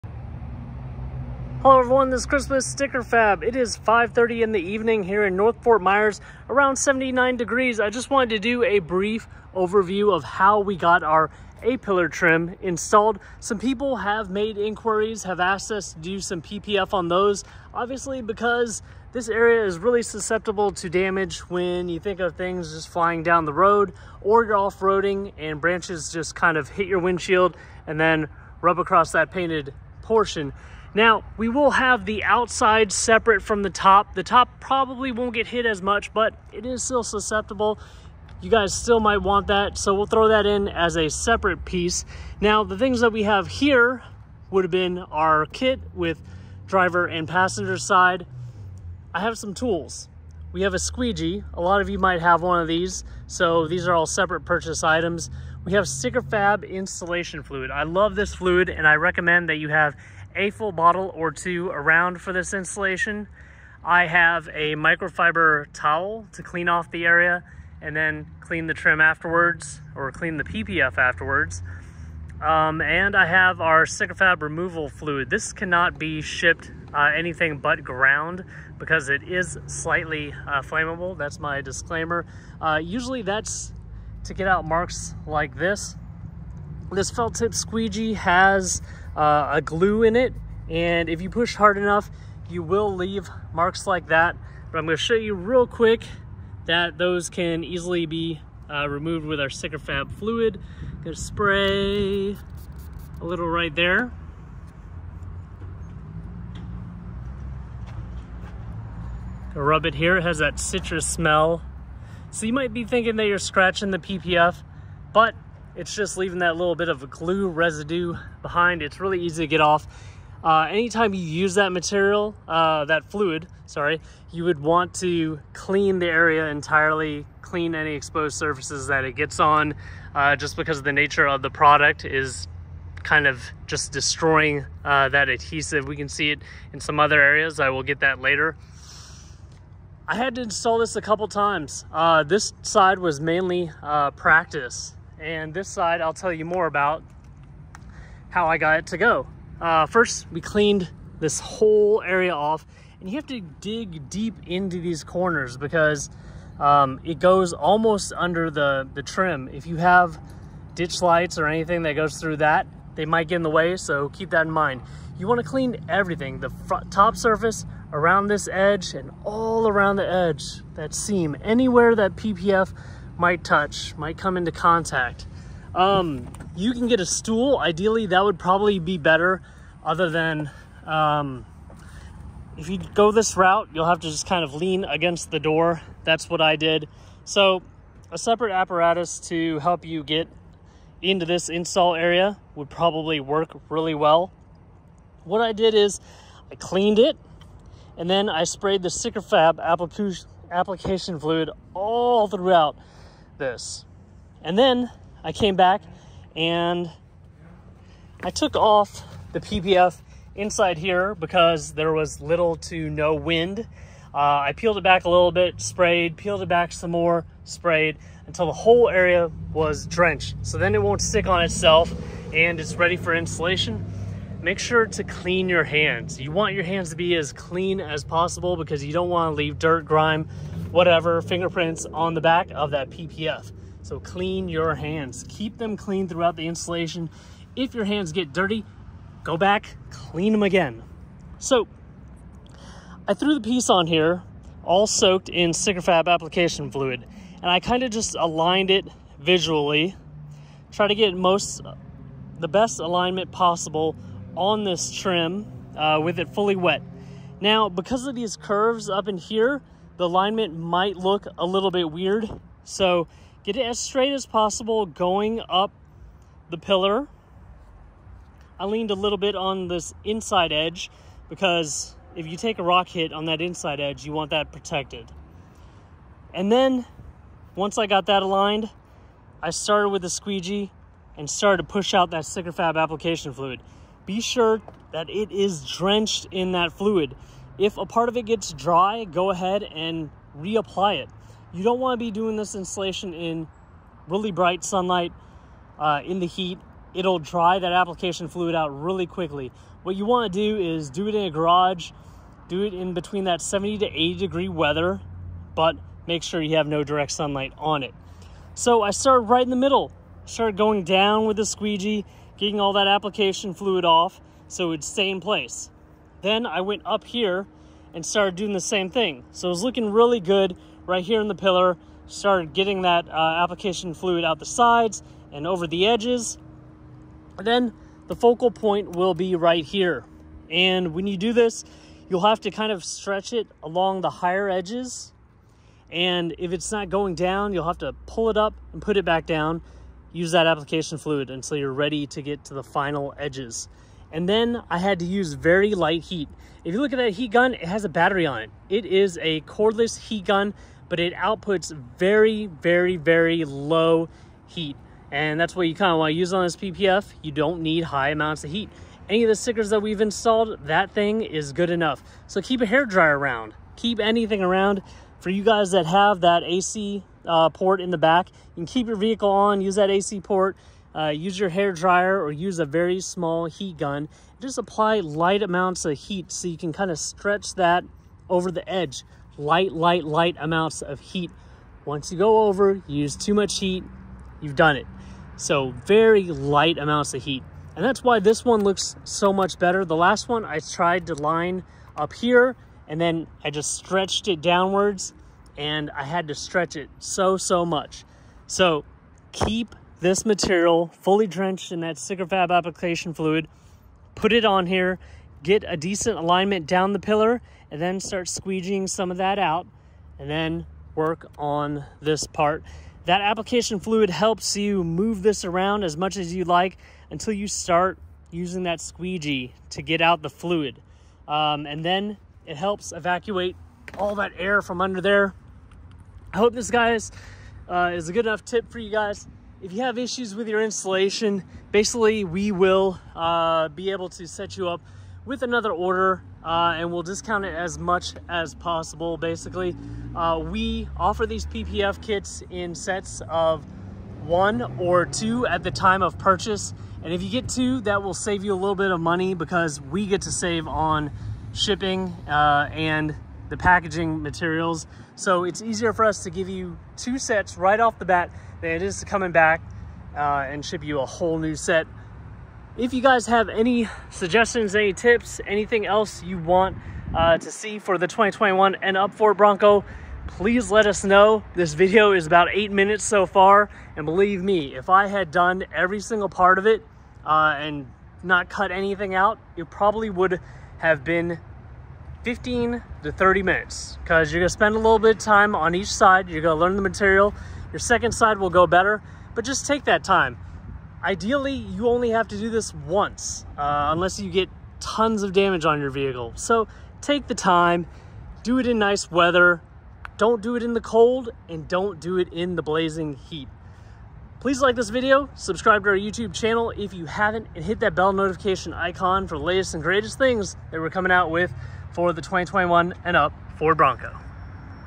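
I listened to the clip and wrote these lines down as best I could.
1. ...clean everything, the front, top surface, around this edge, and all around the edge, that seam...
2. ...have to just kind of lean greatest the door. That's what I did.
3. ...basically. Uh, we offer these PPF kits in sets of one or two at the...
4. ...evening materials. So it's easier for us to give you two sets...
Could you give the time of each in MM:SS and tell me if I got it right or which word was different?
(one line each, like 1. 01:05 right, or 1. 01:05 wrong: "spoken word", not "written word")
1. 02:45 right
2. 03:03 wrong: "against", not "greatest"
3. 07:19 right
4. 07:33 wrong: "packaging", not "evening".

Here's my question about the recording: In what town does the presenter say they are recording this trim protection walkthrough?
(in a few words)
North Fort Myers.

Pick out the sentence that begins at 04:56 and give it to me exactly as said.
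It'll dry that application fluid out really quickly.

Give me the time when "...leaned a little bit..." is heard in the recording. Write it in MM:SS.
04:28.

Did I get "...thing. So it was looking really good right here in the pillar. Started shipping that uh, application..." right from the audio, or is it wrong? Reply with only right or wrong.
wrong.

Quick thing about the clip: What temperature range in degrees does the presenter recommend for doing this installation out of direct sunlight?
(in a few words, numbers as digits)
70 to 80 degrees.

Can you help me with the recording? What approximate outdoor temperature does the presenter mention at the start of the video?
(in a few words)
79 degrees.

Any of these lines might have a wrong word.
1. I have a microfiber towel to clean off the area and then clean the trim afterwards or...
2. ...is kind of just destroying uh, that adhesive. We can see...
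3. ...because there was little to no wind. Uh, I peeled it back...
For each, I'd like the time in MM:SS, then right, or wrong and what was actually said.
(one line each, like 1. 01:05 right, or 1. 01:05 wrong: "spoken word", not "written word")
1. 01:03 right
2. 02:12 right
3. 03:31 right.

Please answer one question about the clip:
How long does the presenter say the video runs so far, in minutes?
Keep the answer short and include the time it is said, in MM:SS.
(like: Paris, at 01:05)
8 minutes, at 07:52.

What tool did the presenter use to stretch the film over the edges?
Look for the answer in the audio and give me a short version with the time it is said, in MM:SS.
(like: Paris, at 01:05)
cordless heat gun, at 05:49.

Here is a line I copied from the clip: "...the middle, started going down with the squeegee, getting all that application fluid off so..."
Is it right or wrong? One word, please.
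right.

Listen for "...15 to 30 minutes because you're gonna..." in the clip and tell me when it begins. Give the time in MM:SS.
08:02.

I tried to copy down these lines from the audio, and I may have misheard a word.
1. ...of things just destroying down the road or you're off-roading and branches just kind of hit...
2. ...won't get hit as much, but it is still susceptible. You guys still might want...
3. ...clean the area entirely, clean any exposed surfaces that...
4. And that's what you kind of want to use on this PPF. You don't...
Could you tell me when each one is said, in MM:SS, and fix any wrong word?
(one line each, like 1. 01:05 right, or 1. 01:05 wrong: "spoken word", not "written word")
1. 00:22 wrong: "flying", not "destroying"
2. 00:35 right
3. 02:05 right
4. 05:55 right.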